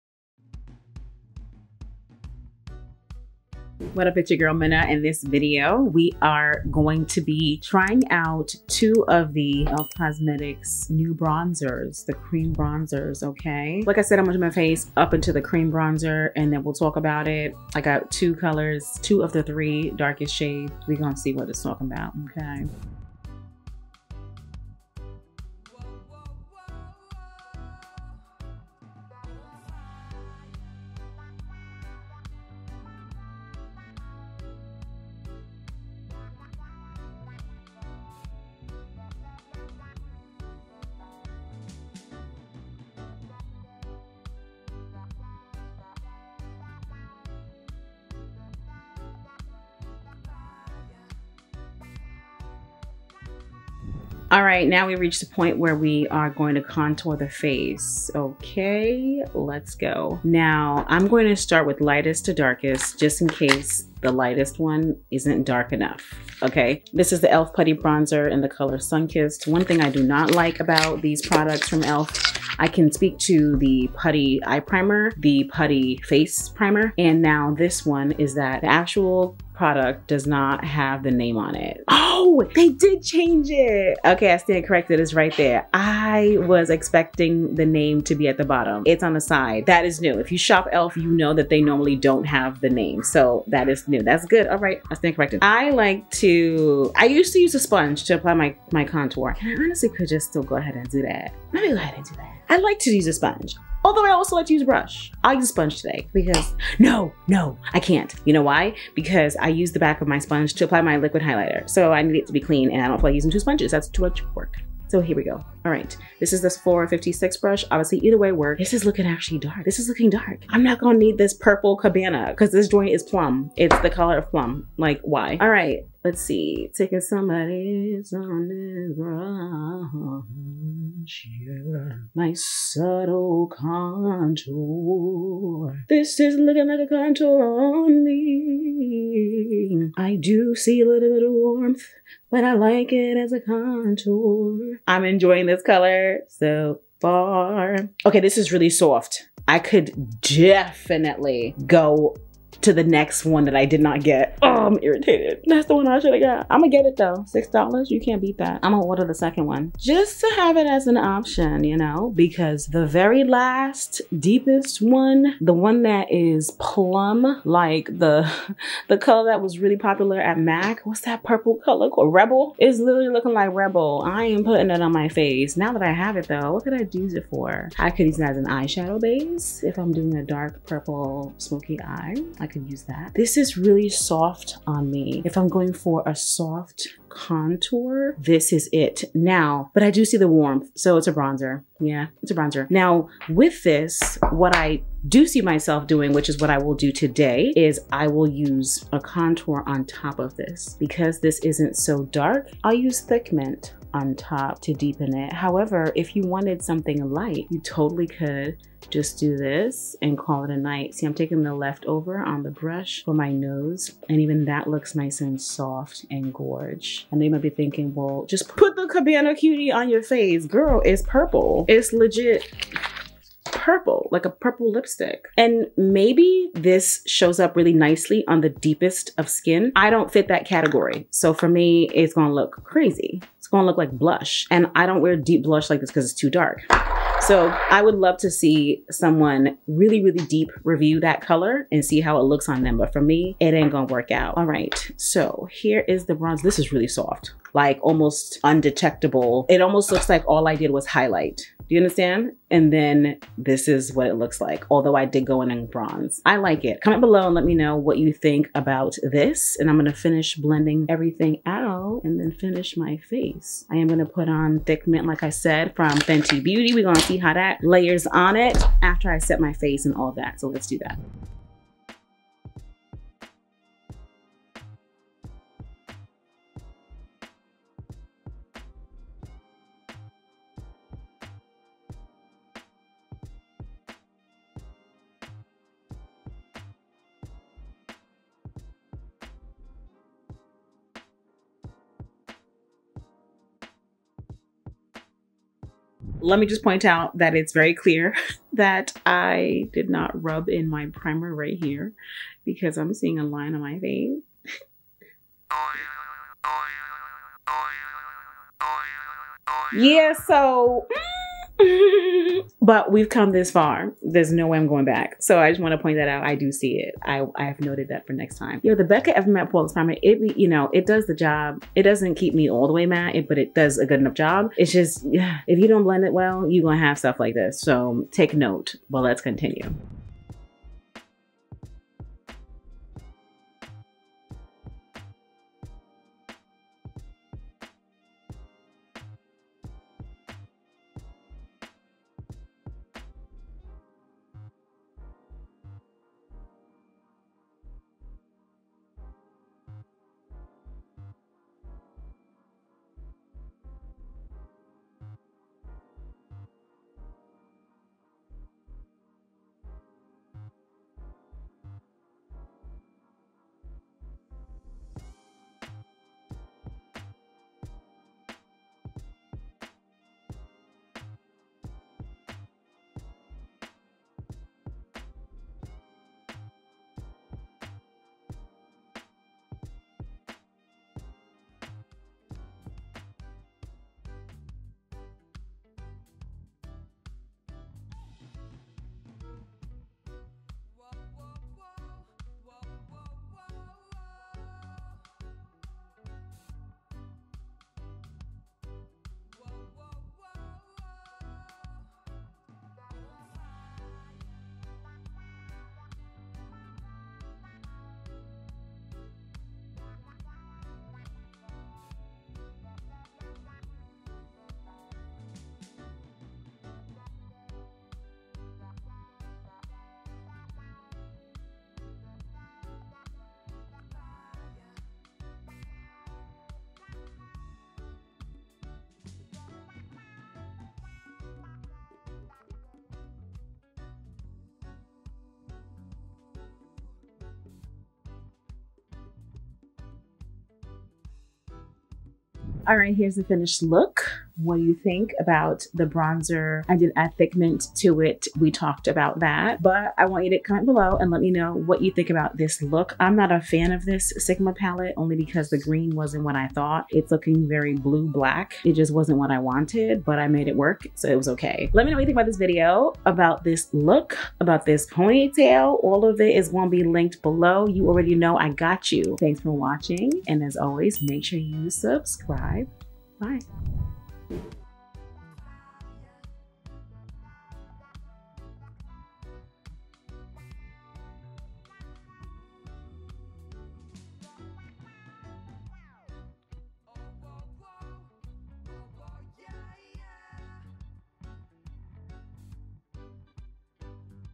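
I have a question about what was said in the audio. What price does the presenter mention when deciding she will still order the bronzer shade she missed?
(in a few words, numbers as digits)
$6.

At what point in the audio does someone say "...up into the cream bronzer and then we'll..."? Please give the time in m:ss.
0:14.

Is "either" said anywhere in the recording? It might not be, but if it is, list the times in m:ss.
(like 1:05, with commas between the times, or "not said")
1:57.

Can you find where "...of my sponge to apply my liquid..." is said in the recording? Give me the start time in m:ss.
1:50.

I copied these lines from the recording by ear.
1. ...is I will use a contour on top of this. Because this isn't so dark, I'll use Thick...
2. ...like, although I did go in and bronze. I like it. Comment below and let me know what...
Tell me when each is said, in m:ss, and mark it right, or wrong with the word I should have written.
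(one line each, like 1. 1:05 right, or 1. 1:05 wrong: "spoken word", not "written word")
1. 3:17 right
2. 4:14 right.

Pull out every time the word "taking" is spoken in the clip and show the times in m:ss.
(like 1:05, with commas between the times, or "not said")
2:06, 3:31.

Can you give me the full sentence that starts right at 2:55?
Now that I have it though, what could I use it for?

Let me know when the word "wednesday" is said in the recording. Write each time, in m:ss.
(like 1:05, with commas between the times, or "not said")
not said.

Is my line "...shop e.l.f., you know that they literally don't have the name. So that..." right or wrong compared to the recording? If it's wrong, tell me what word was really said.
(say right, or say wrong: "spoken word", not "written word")
wrong: "normally", not "literally".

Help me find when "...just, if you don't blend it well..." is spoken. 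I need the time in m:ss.
5:24.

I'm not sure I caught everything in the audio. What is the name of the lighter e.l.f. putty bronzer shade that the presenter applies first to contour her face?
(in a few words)
Sunkissed.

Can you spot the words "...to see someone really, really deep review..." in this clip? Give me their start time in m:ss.
3:58.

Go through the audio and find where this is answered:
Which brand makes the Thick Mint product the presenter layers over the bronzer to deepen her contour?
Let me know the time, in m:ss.
4:25.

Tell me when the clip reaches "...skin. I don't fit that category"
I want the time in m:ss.
3:49.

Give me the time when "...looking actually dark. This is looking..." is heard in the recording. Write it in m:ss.
1:58.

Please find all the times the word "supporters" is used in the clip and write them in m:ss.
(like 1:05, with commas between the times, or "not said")
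not said.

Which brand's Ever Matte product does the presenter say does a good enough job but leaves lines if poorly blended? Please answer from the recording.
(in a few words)
Becca.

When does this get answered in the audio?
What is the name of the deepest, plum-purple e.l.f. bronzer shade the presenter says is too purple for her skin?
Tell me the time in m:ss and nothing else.
3:38.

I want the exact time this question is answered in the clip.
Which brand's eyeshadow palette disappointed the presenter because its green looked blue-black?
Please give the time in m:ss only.
7:34.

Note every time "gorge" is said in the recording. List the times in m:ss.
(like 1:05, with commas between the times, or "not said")
3:36.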